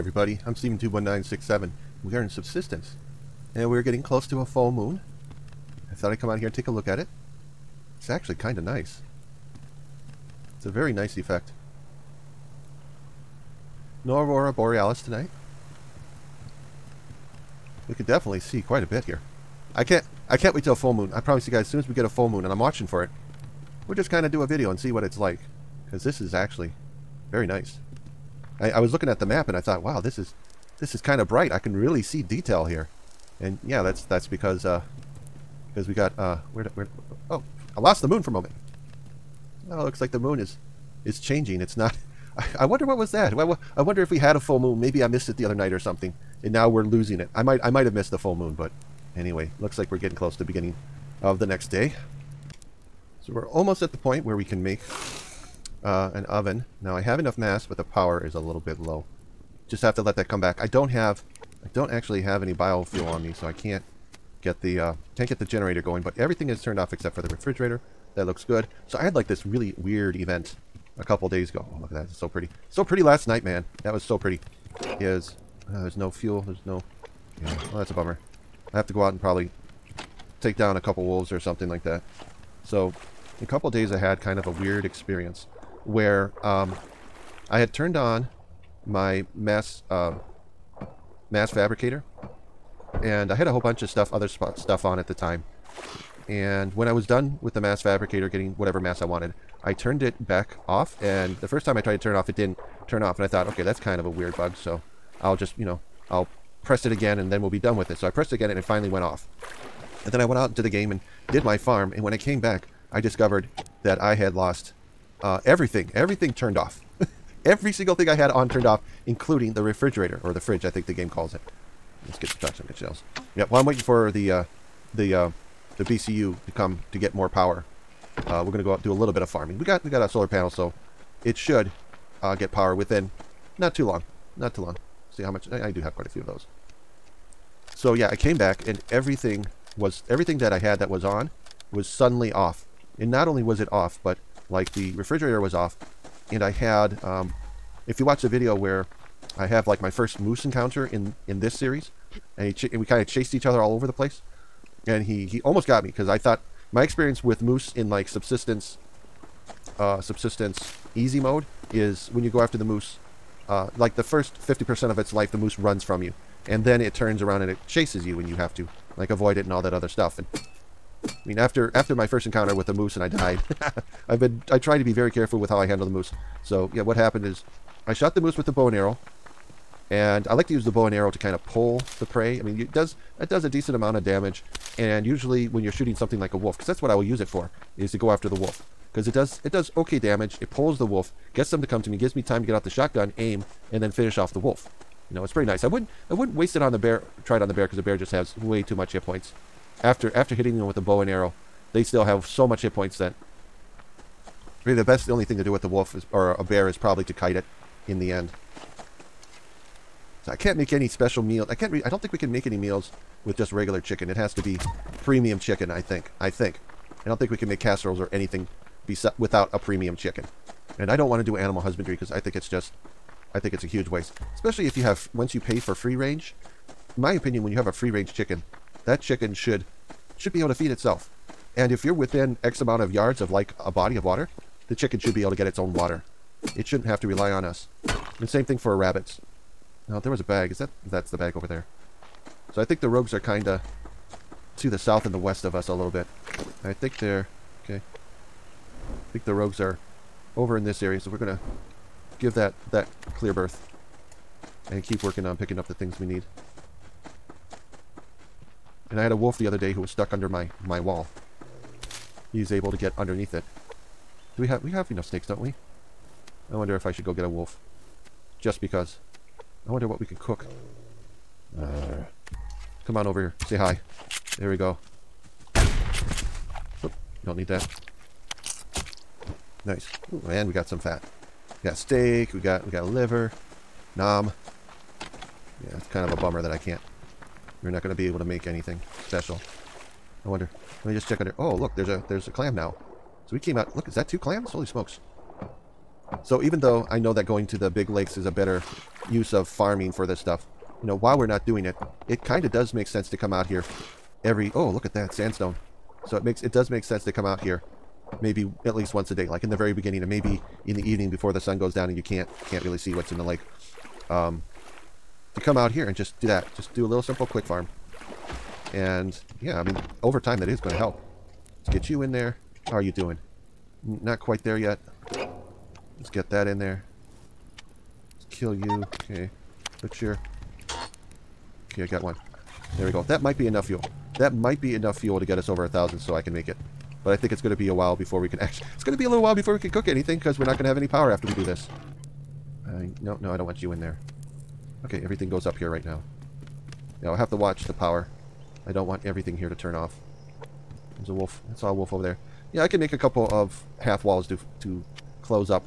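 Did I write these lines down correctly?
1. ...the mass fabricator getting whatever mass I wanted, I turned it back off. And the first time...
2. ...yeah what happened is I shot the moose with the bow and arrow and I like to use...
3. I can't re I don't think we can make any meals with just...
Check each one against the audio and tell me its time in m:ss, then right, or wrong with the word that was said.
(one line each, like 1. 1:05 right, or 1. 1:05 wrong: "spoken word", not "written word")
1. 1:37 right
2. 2:56 right
3. 3:31 right.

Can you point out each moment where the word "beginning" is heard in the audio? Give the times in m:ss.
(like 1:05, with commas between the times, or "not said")
0:50, 5:09.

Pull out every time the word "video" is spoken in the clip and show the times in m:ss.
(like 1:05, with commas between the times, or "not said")
0:24, 2:28.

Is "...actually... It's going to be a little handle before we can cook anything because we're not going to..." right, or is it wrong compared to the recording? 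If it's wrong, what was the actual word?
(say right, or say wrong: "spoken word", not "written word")
wrong: "while", not "handle".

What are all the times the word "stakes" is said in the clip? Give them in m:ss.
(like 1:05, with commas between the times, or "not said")
4:25.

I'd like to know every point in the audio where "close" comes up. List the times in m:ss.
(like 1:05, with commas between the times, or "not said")
0:04, 0:50.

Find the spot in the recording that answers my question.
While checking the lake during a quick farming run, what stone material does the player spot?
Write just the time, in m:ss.
5:05.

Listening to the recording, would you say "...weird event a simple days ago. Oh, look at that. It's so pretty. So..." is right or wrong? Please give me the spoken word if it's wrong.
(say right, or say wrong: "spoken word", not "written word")
wrong: "couple", not "simple".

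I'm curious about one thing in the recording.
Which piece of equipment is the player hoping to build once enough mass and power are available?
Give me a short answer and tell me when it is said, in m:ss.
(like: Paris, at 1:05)
an oven, at 0:56.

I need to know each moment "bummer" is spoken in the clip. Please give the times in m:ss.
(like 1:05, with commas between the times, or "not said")
1:17, 4:46.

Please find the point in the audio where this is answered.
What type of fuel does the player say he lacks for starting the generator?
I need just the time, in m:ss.
1:02.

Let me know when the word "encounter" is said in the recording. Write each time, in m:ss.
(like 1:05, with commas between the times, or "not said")
2:30, 2:52.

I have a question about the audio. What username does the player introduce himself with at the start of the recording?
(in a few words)
Stephentube1967.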